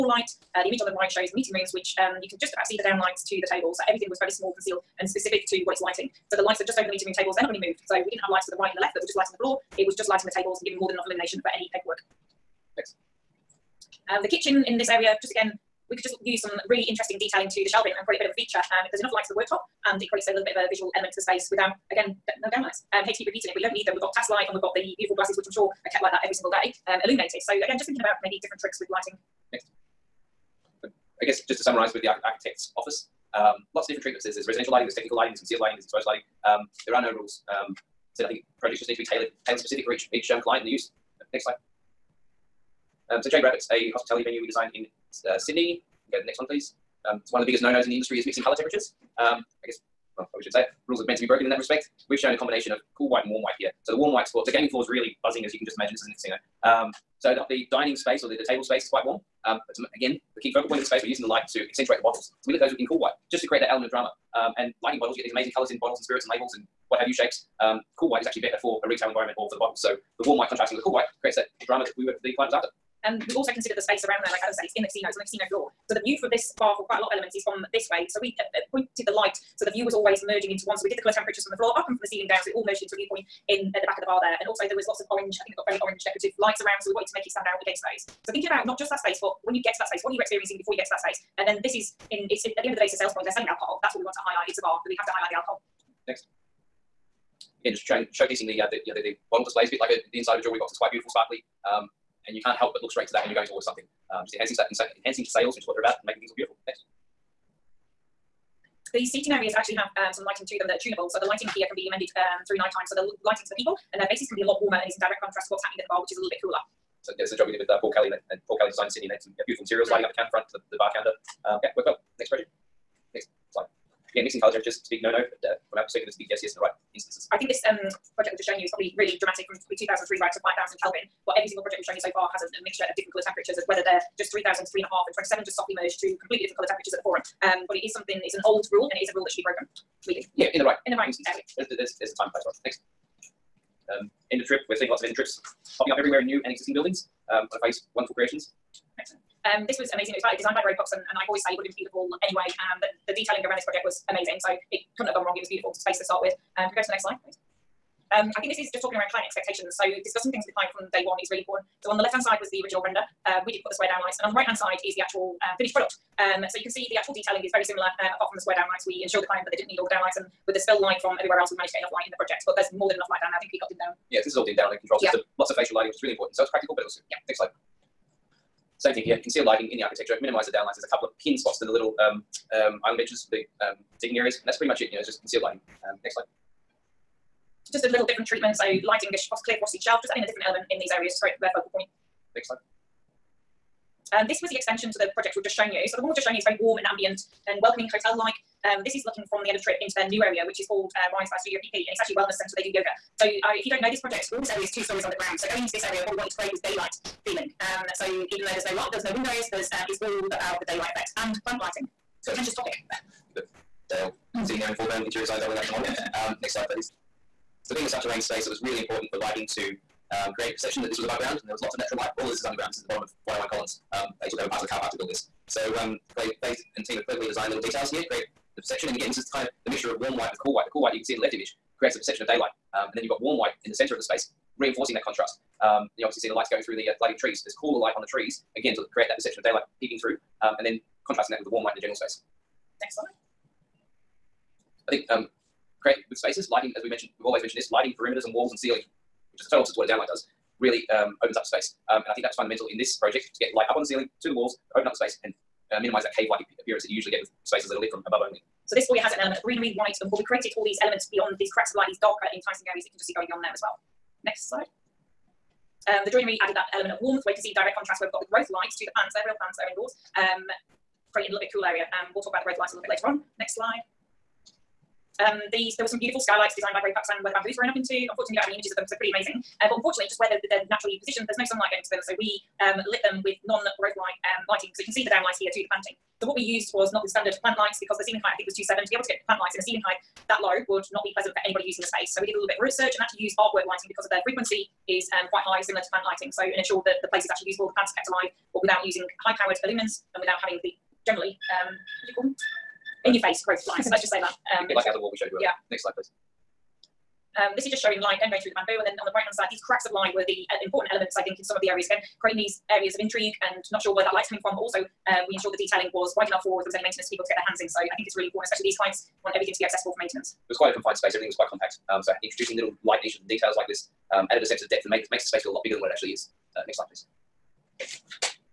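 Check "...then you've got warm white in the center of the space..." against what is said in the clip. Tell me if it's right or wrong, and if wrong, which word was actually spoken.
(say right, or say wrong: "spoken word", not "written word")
right.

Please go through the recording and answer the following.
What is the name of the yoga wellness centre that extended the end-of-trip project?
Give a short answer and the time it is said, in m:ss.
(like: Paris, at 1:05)
Rise, at 3:21.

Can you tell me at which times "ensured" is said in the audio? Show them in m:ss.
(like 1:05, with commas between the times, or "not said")
2:49, 4:56, 5:15.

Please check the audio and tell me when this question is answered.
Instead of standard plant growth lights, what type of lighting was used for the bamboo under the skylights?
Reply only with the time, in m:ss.
4:53.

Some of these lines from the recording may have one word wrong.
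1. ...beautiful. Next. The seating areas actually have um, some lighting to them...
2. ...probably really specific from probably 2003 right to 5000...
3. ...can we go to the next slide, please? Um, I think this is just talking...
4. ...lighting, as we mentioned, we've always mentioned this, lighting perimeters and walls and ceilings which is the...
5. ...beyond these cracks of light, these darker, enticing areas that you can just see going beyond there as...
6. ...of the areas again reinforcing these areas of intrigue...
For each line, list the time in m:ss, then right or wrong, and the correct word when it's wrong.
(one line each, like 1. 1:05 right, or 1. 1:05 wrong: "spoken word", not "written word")
1. 1:46 right
2. 2:08 wrong: "dramatic", not "specific"
3. 2:36 right
4. 4:06 right
5. 4:21 right
6. 5:11 wrong: "creating", not "reinforcing".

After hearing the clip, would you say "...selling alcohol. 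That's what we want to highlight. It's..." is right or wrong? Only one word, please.
right.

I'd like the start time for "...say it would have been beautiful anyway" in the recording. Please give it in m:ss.
2:31.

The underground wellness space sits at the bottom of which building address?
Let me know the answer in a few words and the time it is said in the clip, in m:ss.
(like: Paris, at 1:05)
101 Collins, at 3:43.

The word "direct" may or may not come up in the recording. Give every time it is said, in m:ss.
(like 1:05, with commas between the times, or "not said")
1:55, 4:27.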